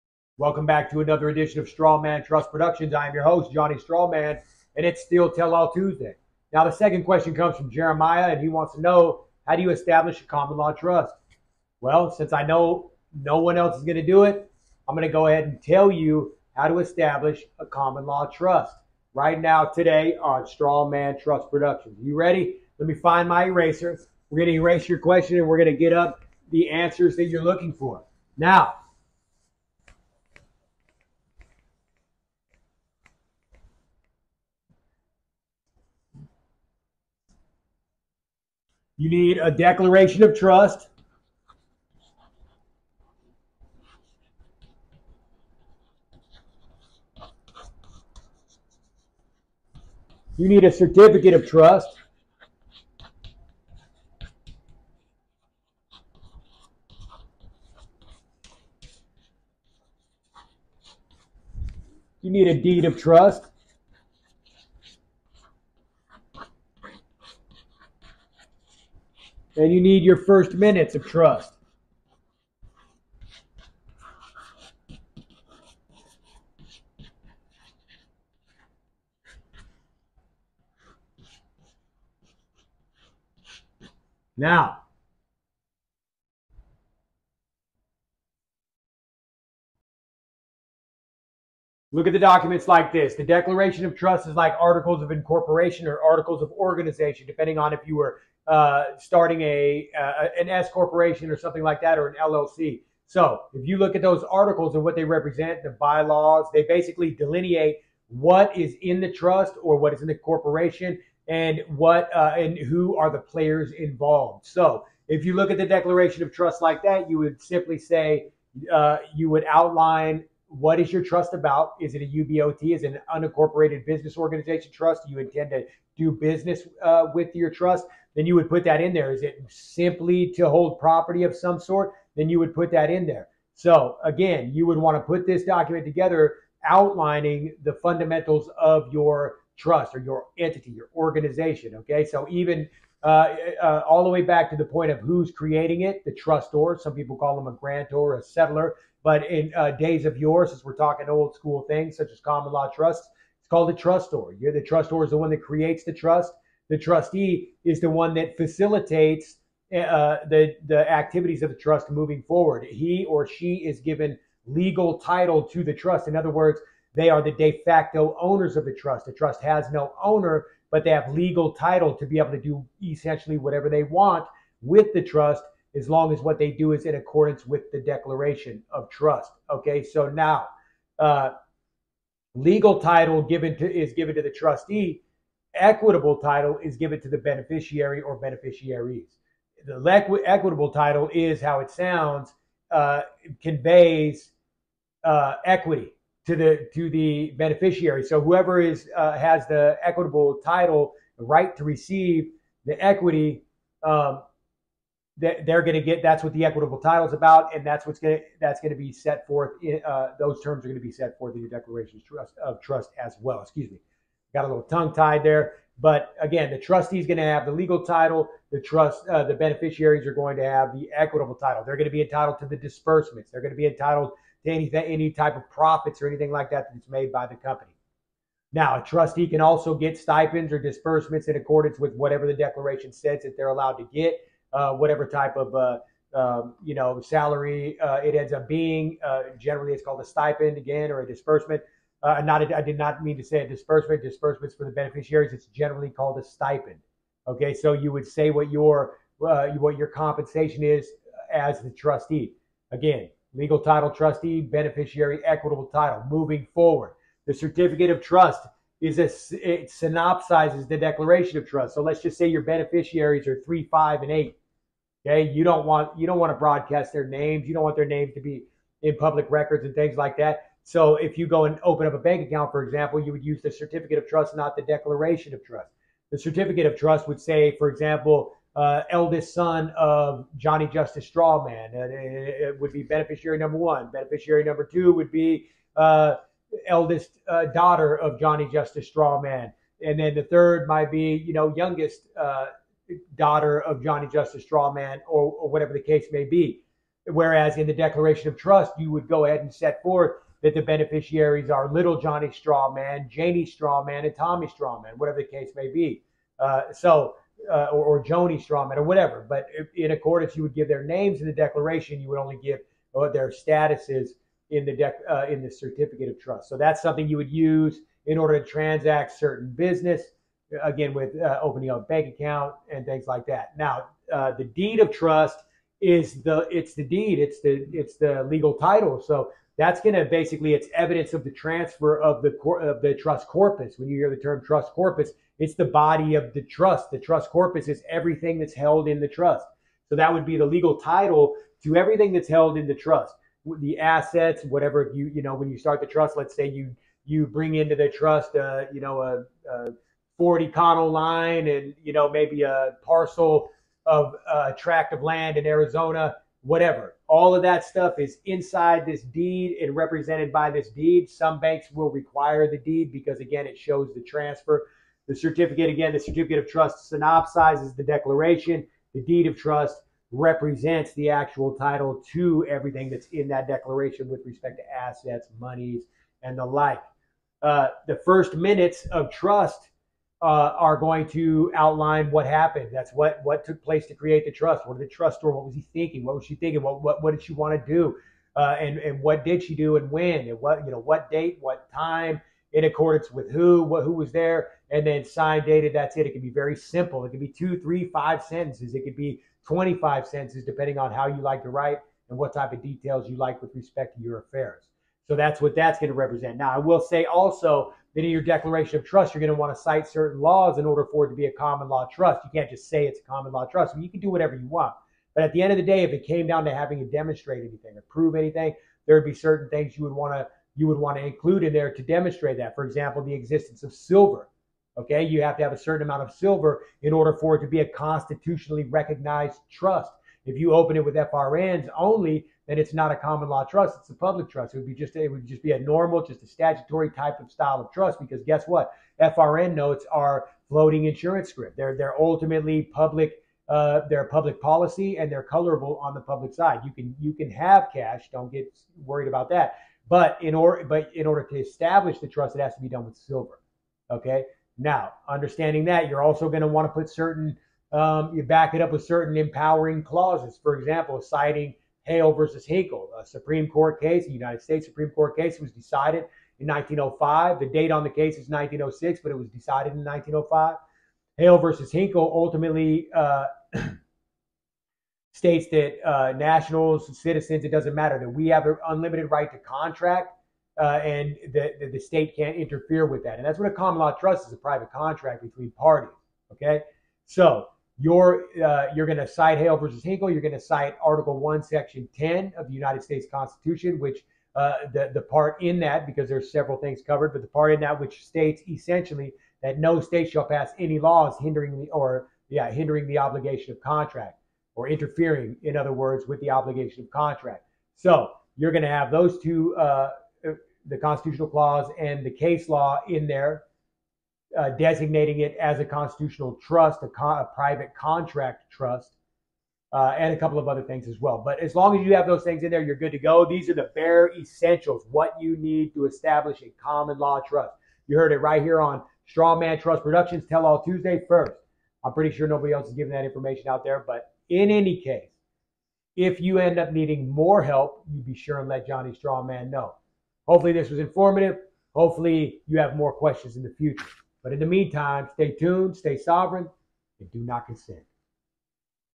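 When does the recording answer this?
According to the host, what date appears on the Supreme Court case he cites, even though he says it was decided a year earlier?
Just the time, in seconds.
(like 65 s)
468 s.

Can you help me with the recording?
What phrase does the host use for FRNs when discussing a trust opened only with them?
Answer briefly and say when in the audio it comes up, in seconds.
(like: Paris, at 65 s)
floating insurance script, at 440 s.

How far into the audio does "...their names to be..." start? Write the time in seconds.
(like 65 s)
267 s.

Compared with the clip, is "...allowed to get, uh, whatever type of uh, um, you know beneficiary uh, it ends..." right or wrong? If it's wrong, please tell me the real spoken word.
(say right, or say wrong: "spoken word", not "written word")
wrong: "salary", not "beneficiary".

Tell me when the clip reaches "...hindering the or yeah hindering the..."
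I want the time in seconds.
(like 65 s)
501 s.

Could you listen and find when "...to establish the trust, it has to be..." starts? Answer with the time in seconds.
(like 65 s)
451 s.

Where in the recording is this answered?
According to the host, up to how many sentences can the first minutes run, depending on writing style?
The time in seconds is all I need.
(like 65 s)
399 s.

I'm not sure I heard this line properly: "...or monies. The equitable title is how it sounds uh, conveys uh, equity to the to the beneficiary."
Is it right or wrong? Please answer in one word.
wrong.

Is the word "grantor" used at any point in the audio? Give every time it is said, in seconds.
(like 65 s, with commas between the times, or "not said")
147 s.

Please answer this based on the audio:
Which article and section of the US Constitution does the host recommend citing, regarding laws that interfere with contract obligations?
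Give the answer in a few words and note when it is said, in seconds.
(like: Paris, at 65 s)
Article One, Section Ten, at 490 s.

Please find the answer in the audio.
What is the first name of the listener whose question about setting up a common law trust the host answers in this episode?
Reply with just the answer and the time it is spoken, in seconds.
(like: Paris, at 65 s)
Jeremiah, at 7 s.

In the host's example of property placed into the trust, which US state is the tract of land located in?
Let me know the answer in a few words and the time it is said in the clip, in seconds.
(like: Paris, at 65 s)
Arizona, at 355 s.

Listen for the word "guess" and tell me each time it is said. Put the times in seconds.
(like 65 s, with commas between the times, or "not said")
438 s.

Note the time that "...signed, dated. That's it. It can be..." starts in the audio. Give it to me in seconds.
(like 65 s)
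395 s.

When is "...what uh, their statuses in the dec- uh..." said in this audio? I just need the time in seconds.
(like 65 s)
312 s.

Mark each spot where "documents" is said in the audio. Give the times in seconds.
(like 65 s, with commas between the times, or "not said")
92 s, 135 s.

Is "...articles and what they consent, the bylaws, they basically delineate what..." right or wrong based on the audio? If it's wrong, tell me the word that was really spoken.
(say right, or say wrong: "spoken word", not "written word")
wrong: "represent", not "consent".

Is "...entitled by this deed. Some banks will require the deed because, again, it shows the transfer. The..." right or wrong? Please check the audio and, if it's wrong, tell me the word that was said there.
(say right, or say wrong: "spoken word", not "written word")
wrong: "represented", not "entitled".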